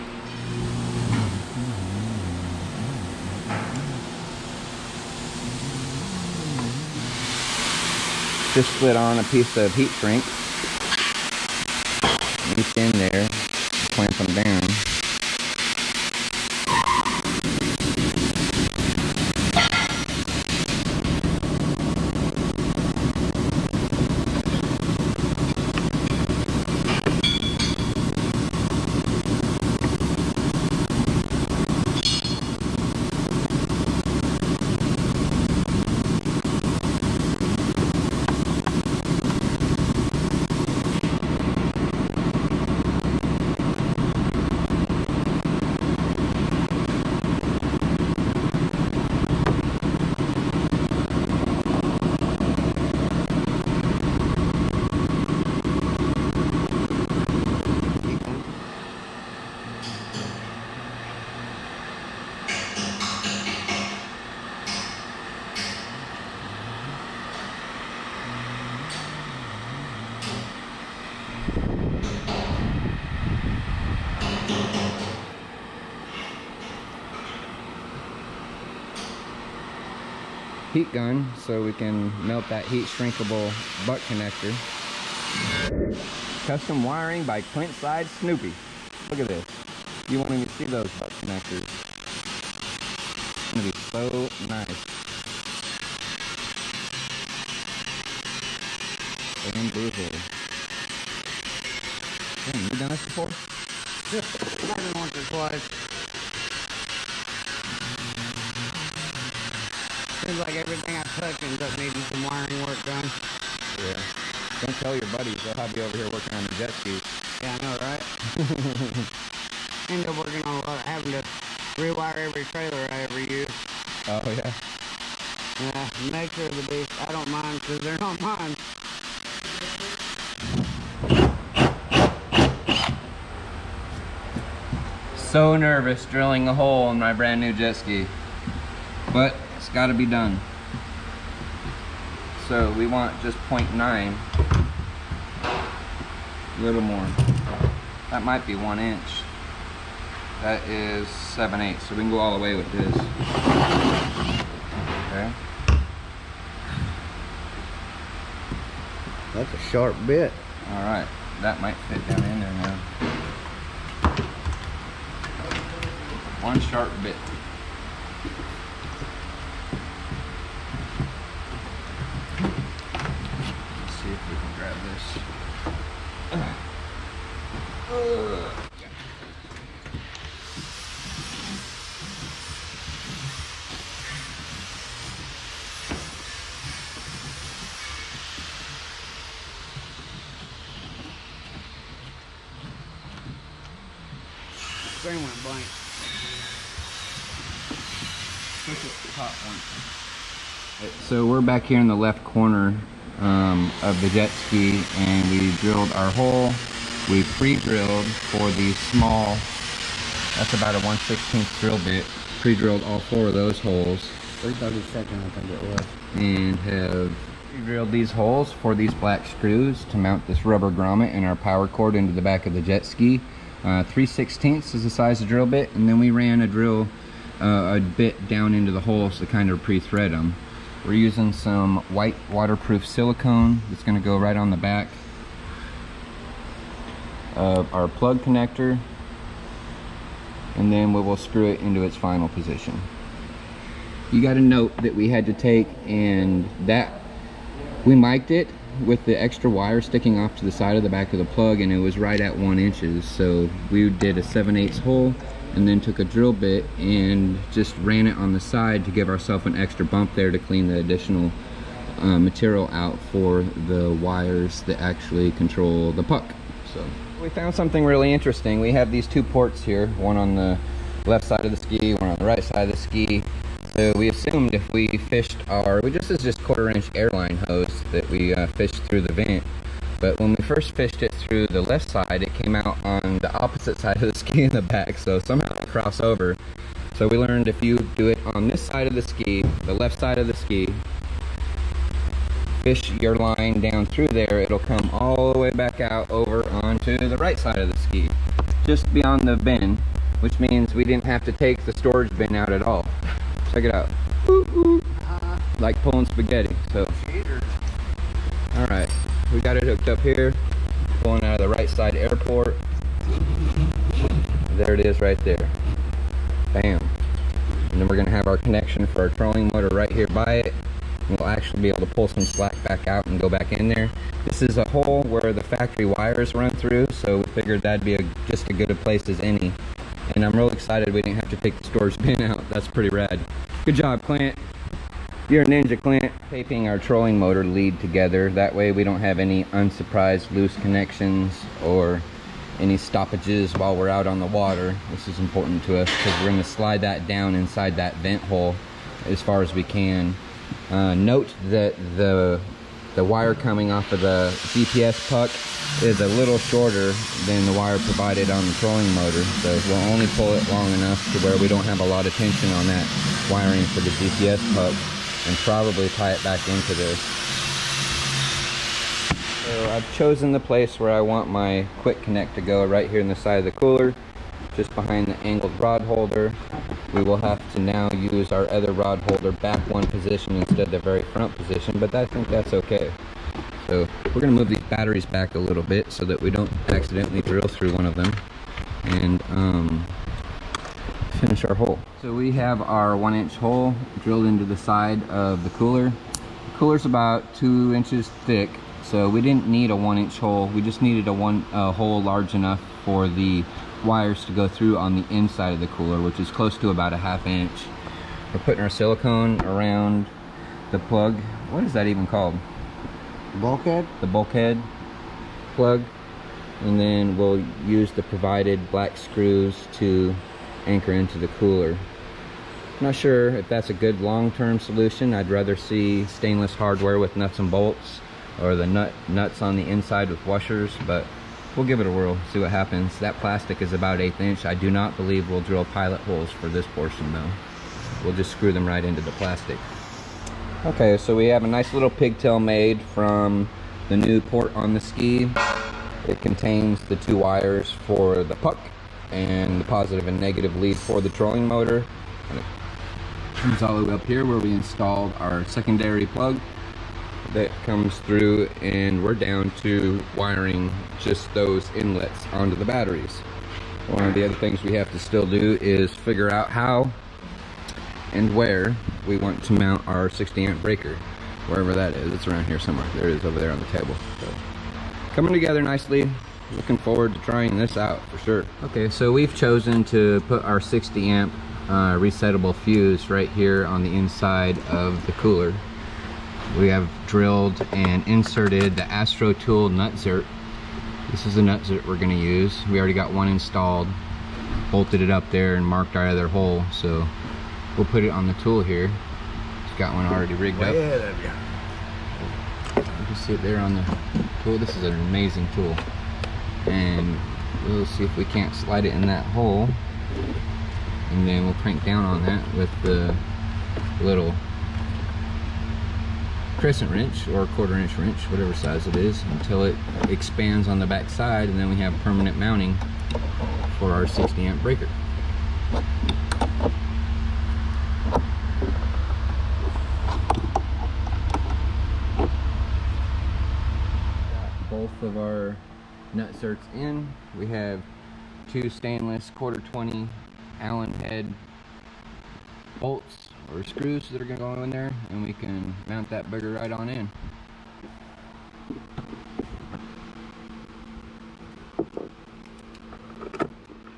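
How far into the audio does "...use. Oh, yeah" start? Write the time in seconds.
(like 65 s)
123 s.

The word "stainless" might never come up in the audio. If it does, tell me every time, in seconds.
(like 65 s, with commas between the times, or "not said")
426 s, 538 s.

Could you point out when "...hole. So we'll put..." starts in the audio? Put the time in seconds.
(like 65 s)
496 s.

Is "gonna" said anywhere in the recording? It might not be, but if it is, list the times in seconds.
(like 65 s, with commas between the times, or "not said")
93 s, 317 s, 384 s, 491 s.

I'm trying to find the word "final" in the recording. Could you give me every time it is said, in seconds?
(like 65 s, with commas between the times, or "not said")
241 s.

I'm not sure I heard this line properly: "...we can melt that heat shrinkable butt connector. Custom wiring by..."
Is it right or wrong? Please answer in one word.
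right.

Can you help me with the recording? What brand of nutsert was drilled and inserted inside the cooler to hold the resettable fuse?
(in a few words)
Astro Tool.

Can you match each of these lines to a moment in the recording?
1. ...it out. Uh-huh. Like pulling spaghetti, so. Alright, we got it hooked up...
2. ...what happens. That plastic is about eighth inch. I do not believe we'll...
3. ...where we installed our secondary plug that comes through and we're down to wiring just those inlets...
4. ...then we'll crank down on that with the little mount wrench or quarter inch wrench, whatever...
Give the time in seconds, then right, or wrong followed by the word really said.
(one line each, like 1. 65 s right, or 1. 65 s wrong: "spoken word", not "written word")
1. 303 s right
2. 432 s right
3. 454 s right
4. 511 s wrong: "crescent", not "mount".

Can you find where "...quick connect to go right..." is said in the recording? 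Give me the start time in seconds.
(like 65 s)
371 s.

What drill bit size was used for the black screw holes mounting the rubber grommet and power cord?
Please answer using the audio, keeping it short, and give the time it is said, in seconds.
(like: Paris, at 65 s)
3/16, at 223 s.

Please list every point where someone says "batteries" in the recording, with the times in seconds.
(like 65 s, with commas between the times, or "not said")
384 s, 462 s.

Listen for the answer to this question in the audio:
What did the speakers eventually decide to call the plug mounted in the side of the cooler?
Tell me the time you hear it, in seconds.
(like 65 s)
414 s.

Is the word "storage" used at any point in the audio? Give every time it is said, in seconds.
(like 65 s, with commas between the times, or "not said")
301 s, 331 s.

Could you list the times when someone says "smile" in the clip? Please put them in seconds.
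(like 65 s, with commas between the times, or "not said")
not said.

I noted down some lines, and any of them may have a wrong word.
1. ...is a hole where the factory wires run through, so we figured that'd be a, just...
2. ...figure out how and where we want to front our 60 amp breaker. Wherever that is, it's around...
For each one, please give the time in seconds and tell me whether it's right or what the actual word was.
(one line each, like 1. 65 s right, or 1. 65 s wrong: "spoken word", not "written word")
1. 324 s right
2. 465 s wrong: "mount", not "front".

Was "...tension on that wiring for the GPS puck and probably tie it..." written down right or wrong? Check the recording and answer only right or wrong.
right.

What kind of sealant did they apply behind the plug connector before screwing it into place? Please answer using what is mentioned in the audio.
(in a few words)
white waterproof silicone.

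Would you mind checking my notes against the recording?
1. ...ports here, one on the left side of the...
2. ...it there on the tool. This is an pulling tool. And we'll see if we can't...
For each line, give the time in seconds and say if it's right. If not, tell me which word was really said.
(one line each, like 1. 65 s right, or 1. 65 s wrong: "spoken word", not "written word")
1. 269 s right
2. 503 s wrong: "amazing", not "pulling".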